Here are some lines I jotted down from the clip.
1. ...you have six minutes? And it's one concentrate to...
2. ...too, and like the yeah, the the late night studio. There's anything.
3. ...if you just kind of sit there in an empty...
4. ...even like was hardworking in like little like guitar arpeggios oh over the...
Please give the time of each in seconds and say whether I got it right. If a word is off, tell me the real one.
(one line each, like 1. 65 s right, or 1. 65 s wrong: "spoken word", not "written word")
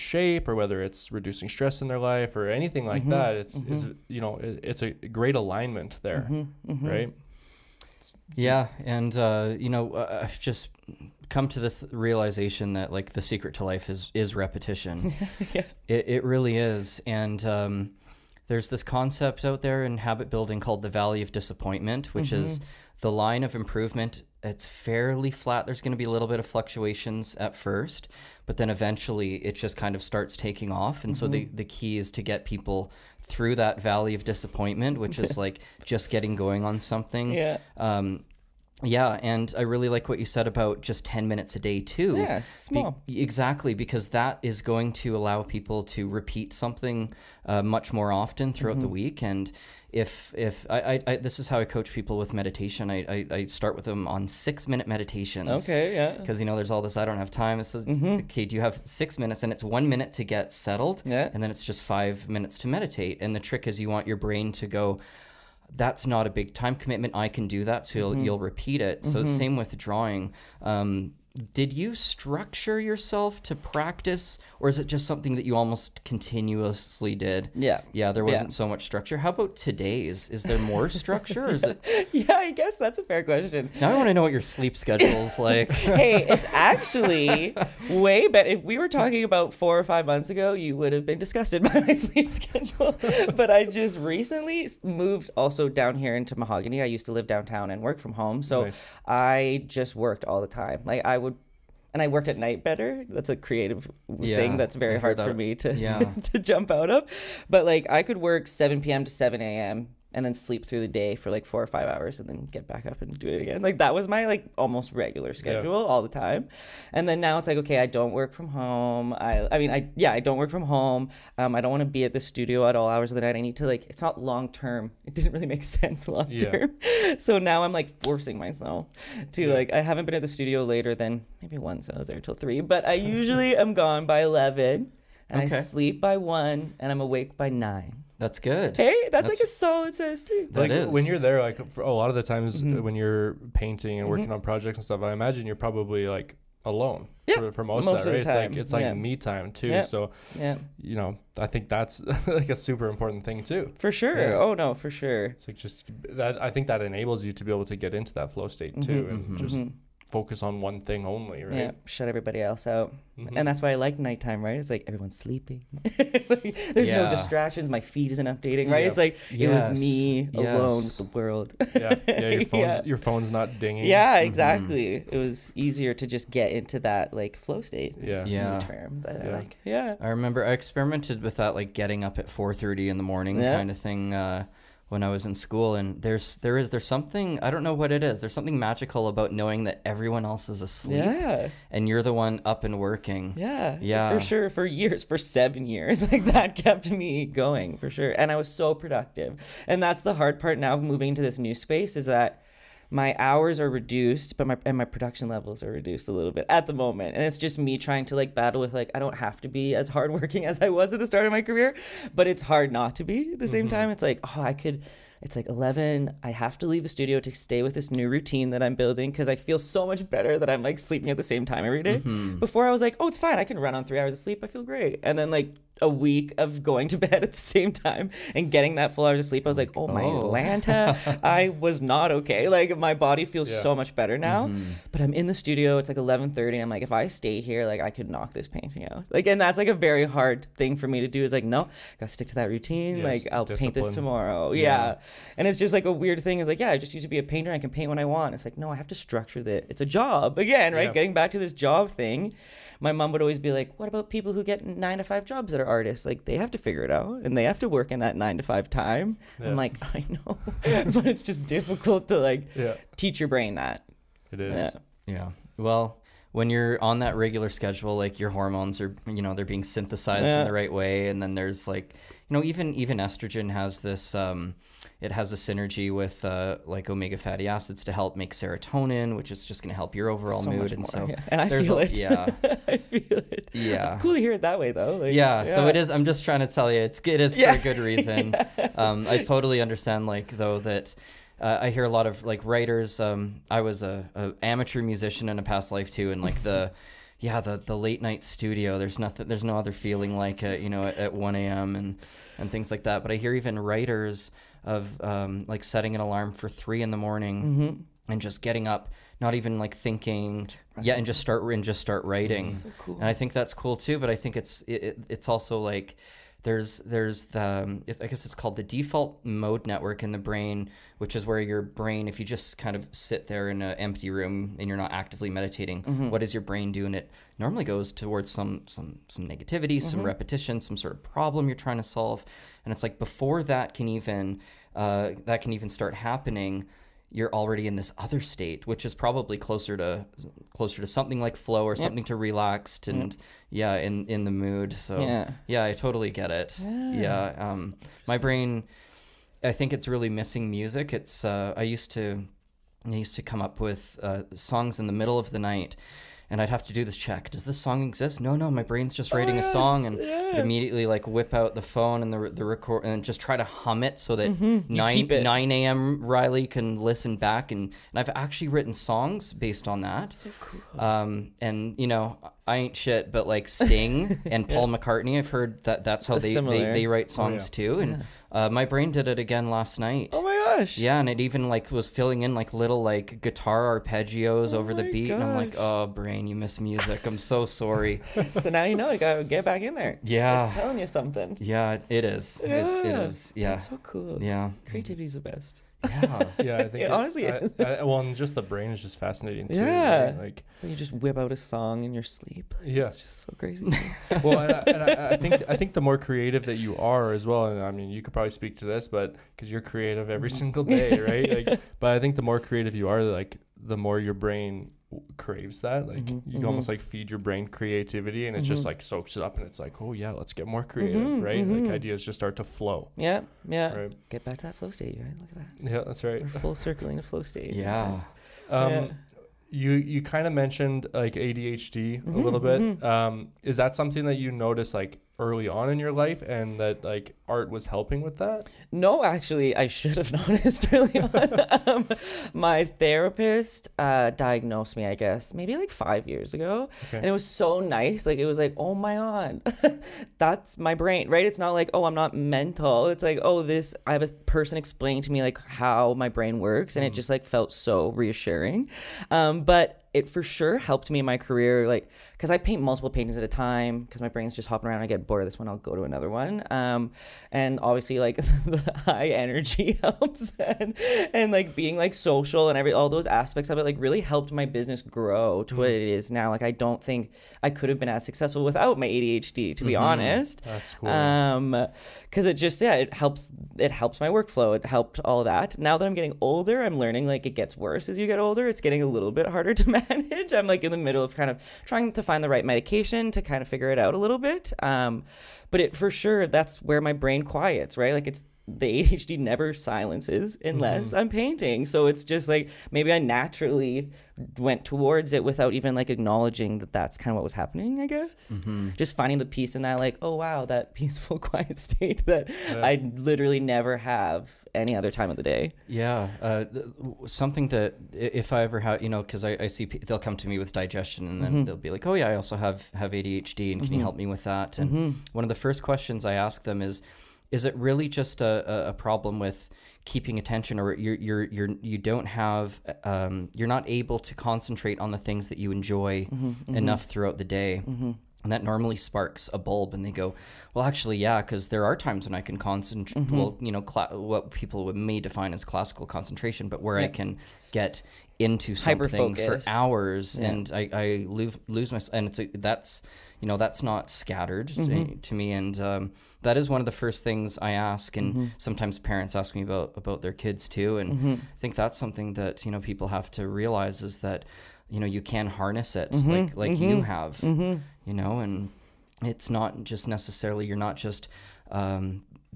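1. 58 s wrong: "minute", not "concentrate"
2. 295 s wrong: "nothing", not "anything"
3. 322 s right
4. 381 s wrong: "filling", not "hardworking".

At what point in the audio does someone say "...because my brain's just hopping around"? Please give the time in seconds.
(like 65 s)
463 s.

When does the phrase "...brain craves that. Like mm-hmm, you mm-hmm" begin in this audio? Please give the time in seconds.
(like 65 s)
414 s.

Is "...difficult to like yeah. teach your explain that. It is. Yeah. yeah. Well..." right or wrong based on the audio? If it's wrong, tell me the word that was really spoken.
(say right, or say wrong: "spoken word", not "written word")
wrong: "brain", not "explain".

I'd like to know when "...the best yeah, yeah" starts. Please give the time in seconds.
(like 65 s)
395 s.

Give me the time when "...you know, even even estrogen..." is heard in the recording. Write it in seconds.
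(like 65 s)
272 s.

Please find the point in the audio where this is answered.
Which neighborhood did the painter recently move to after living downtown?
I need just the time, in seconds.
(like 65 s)
96 s.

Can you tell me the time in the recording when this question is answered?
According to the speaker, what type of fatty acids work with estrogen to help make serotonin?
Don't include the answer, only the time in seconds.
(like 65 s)
276 s.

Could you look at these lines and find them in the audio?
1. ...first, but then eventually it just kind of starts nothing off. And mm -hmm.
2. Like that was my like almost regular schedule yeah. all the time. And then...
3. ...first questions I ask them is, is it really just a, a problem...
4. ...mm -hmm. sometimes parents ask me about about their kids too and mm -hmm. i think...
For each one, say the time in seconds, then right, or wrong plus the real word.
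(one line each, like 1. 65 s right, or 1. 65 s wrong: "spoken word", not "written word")
1. 27 s wrong: "taking", not "nothing"
2. 113 s right
3. 525 s right
4. 558 s right.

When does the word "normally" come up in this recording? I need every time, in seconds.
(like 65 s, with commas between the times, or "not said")
327 s, 538 s.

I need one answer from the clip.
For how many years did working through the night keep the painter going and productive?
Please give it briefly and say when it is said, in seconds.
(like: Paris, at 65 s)
7, at 195 s.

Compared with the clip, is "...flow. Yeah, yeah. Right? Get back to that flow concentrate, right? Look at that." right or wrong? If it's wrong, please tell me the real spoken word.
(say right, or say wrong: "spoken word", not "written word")
wrong: "state", not "concentrate".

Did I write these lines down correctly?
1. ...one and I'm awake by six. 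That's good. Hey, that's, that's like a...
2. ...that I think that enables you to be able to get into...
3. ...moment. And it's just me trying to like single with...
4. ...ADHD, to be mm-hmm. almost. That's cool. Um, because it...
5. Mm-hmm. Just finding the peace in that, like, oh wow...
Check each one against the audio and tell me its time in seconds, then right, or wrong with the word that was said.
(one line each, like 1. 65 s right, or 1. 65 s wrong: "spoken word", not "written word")
1. 136 s wrong: "nine", not "six"
2. 156 s right
3. 206 s wrong: "battle", not "single"
4. 478 s wrong: "honest", not "almost"
5. 508 s right.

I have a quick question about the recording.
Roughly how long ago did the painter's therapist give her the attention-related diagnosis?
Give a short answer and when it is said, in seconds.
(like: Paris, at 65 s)
5 years ago, at 445 s.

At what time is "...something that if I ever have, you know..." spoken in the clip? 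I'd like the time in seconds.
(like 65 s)
517 s.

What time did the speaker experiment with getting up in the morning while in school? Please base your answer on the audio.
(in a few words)
4:30.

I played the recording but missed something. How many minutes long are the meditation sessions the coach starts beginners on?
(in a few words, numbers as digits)
6.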